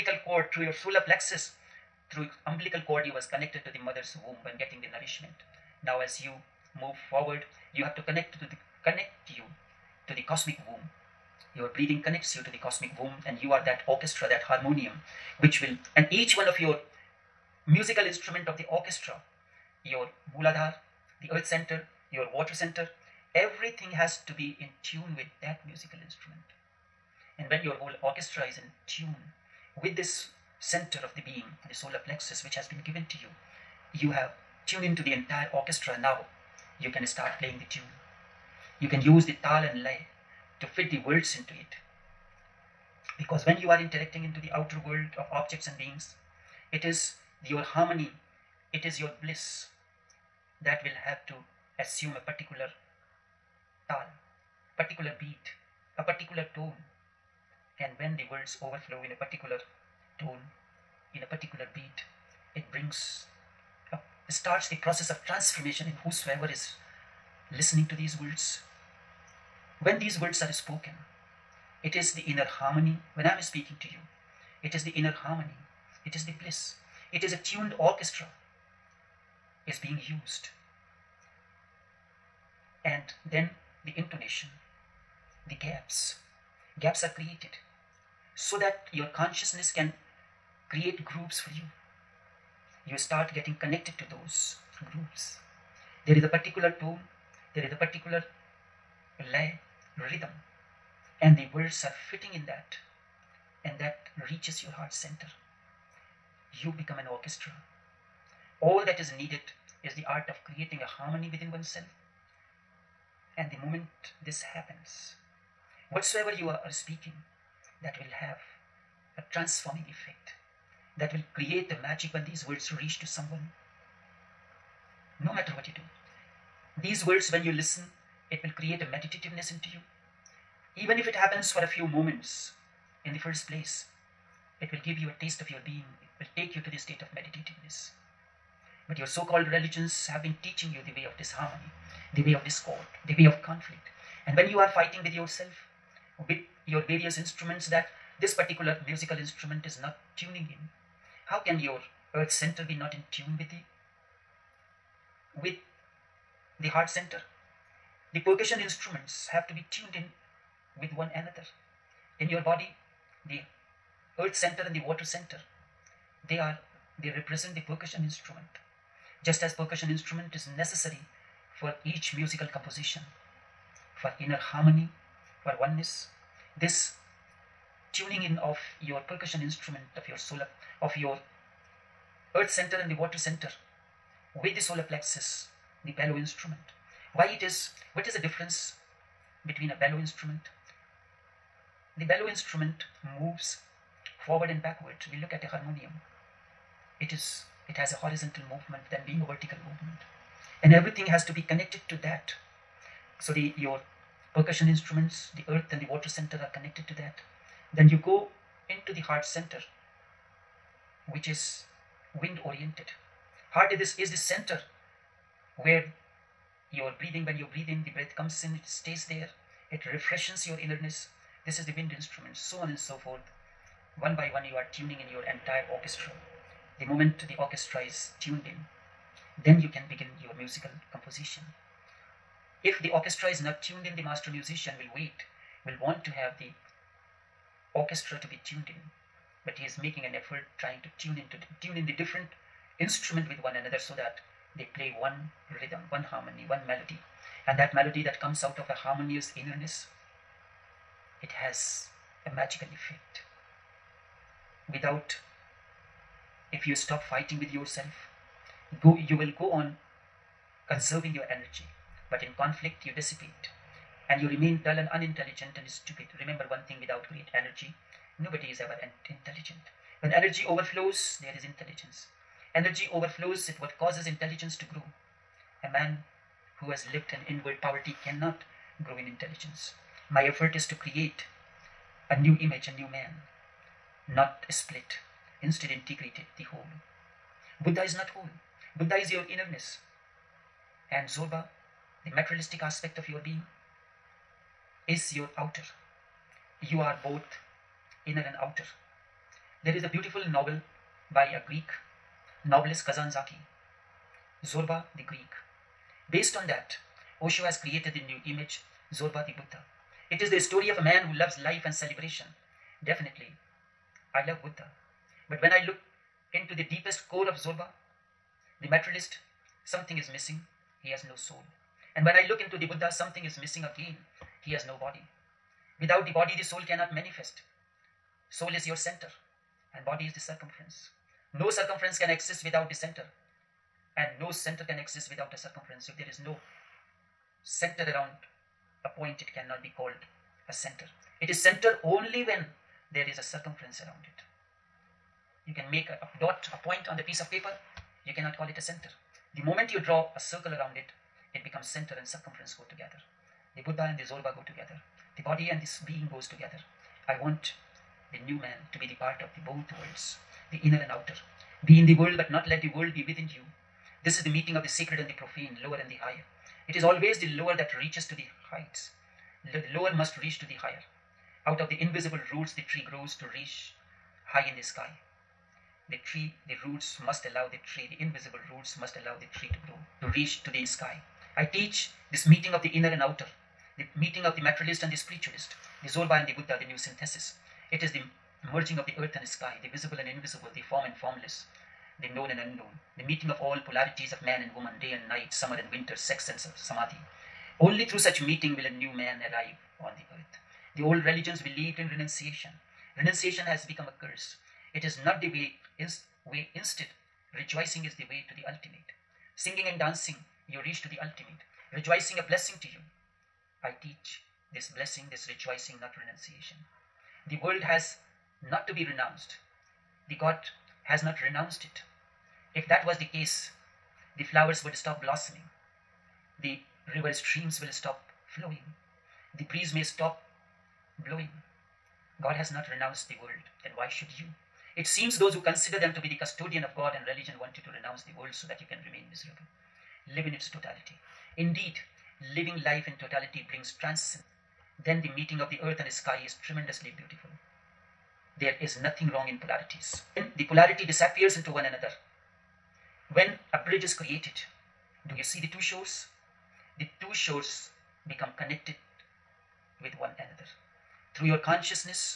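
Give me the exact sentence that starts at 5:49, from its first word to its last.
The moment you draw a circle around it, it becomes center and circumference go together.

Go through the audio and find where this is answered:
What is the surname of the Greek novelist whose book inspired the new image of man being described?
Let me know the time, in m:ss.
5:02.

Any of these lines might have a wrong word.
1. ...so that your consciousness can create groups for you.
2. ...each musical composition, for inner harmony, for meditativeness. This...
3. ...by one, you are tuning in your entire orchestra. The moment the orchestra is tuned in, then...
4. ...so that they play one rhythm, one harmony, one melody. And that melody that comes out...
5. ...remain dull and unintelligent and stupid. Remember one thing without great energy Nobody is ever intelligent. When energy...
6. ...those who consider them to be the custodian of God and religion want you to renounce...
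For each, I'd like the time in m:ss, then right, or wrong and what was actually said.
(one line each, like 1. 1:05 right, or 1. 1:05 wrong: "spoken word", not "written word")
1. 1:28 right
2. 2:51 wrong: "oneness", not "meditativeness"
3. 3:44 right
4. 4:03 right
5. 4:24 right
6. 7:15 right.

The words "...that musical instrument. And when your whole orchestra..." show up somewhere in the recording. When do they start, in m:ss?
0:25.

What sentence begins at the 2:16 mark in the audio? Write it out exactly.
It will take you to the state of meditativeness.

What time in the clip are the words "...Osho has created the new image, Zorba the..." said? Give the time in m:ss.
5:07.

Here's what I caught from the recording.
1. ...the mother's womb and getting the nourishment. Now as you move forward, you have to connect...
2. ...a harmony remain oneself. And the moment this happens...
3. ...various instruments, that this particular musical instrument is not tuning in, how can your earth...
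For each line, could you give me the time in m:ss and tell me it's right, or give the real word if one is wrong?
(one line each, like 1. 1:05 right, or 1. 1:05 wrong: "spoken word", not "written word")
1. 0:03 right
2. 1:50 wrong: "within", not "remain"
3. 2:26 right.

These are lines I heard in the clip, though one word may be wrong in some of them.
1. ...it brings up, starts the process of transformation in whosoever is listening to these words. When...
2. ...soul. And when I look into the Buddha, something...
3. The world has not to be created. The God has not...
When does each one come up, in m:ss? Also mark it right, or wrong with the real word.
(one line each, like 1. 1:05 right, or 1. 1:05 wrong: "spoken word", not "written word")
1. 1:02 right
2. 5:21 right
3. 6:57 wrong: "renounced", not "created".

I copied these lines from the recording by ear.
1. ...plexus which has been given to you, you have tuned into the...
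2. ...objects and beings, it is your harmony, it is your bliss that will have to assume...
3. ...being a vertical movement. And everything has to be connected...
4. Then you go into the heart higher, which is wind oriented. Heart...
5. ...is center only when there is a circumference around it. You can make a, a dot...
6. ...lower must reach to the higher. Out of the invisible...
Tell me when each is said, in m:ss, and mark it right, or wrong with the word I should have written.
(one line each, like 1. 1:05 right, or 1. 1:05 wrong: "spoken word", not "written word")
1. 0:32 right
2. 0:45 right
3. 3:19 right
4. 3:27 wrong: "center", not "higher"
5. 5:41 right
6. 6:09 right.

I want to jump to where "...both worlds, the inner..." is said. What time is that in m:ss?
5:59.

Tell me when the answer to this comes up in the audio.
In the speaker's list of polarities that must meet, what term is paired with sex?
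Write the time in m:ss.
6:36.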